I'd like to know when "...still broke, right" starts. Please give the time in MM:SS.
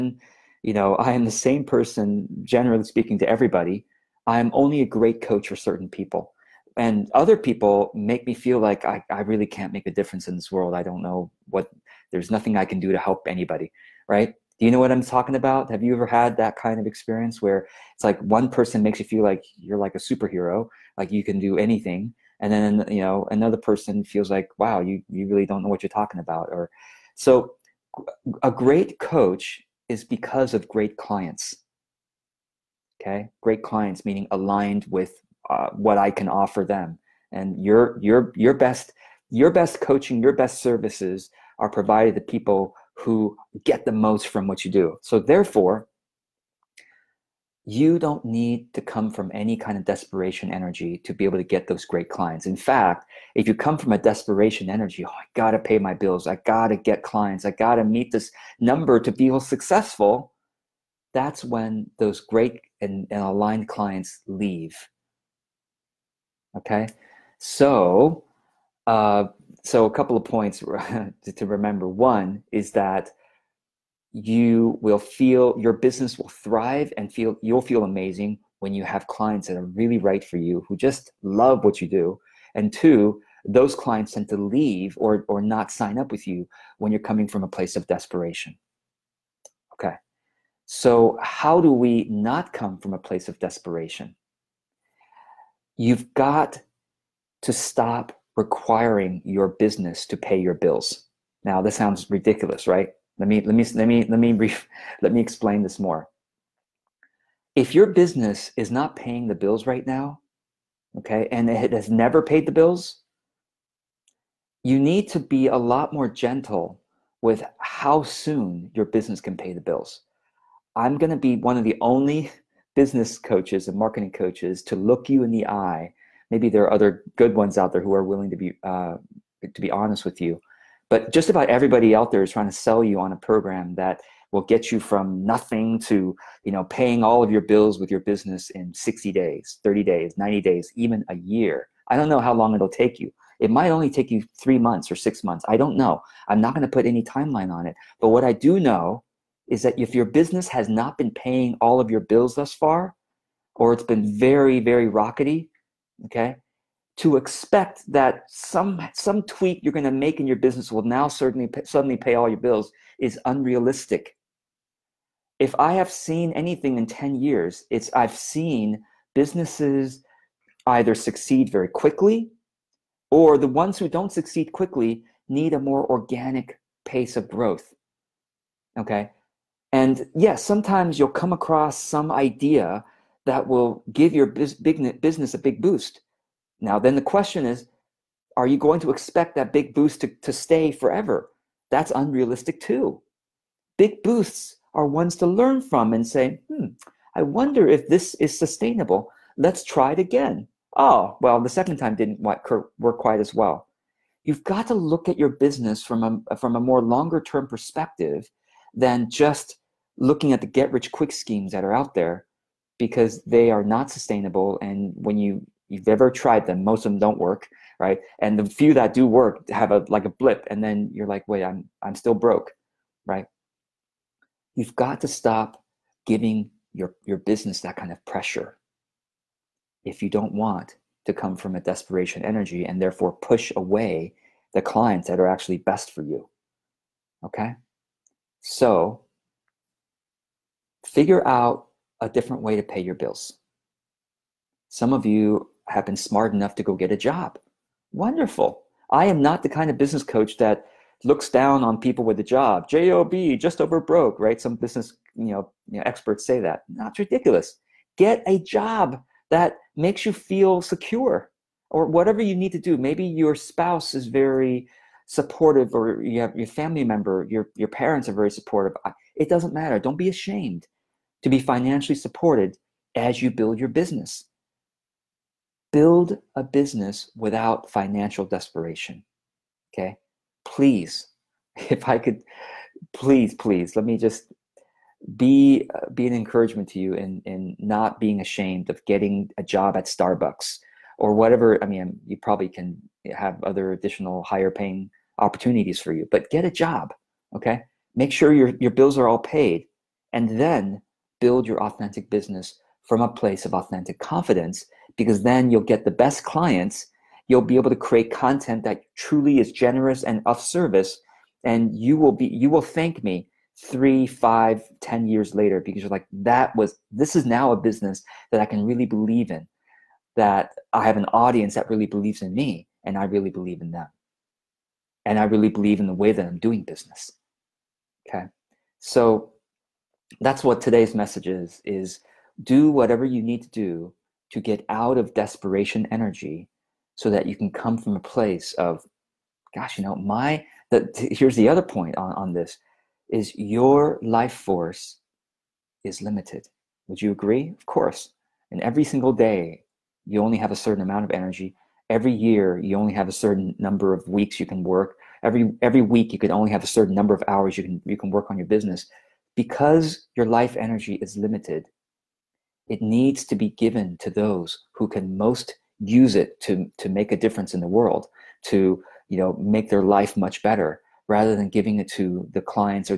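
03:41.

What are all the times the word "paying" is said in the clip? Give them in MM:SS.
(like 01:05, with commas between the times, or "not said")
01:48, 02:16, 02:31, 04:54.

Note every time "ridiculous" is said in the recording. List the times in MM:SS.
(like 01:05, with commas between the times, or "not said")
01:42, 04:16.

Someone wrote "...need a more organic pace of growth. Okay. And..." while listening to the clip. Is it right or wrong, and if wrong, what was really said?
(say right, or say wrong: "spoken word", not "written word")
right.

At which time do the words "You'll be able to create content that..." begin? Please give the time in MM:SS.
05:07.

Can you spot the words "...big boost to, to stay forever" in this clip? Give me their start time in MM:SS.
03:09.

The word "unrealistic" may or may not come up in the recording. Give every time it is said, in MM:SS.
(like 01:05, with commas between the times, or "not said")
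02:43, 03:11.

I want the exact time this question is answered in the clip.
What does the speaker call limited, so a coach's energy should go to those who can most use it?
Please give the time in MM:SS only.
05:44.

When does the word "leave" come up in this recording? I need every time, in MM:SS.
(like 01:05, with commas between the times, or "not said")
01:04, 01:24.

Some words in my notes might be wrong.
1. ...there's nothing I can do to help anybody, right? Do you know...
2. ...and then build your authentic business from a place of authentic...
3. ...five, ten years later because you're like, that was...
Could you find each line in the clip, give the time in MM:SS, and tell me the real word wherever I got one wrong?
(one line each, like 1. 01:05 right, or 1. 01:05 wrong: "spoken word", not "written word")
1. 00:12 right
2. 05:00 right
3. 05:14 right.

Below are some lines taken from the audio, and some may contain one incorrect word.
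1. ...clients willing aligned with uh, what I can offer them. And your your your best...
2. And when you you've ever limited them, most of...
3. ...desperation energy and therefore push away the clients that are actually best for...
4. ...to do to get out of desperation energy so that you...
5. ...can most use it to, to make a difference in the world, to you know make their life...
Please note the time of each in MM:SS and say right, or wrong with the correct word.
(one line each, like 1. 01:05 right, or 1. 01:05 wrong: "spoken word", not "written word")
1. 00:33 wrong: "meaning", not "willing"
2. 03:34 wrong: "tried", not "limited"
3. 03:51 right
4. 05:33 right
5. 06:04 right.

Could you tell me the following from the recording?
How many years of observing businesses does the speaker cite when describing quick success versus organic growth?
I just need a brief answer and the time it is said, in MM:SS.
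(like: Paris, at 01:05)
10, at 02:46.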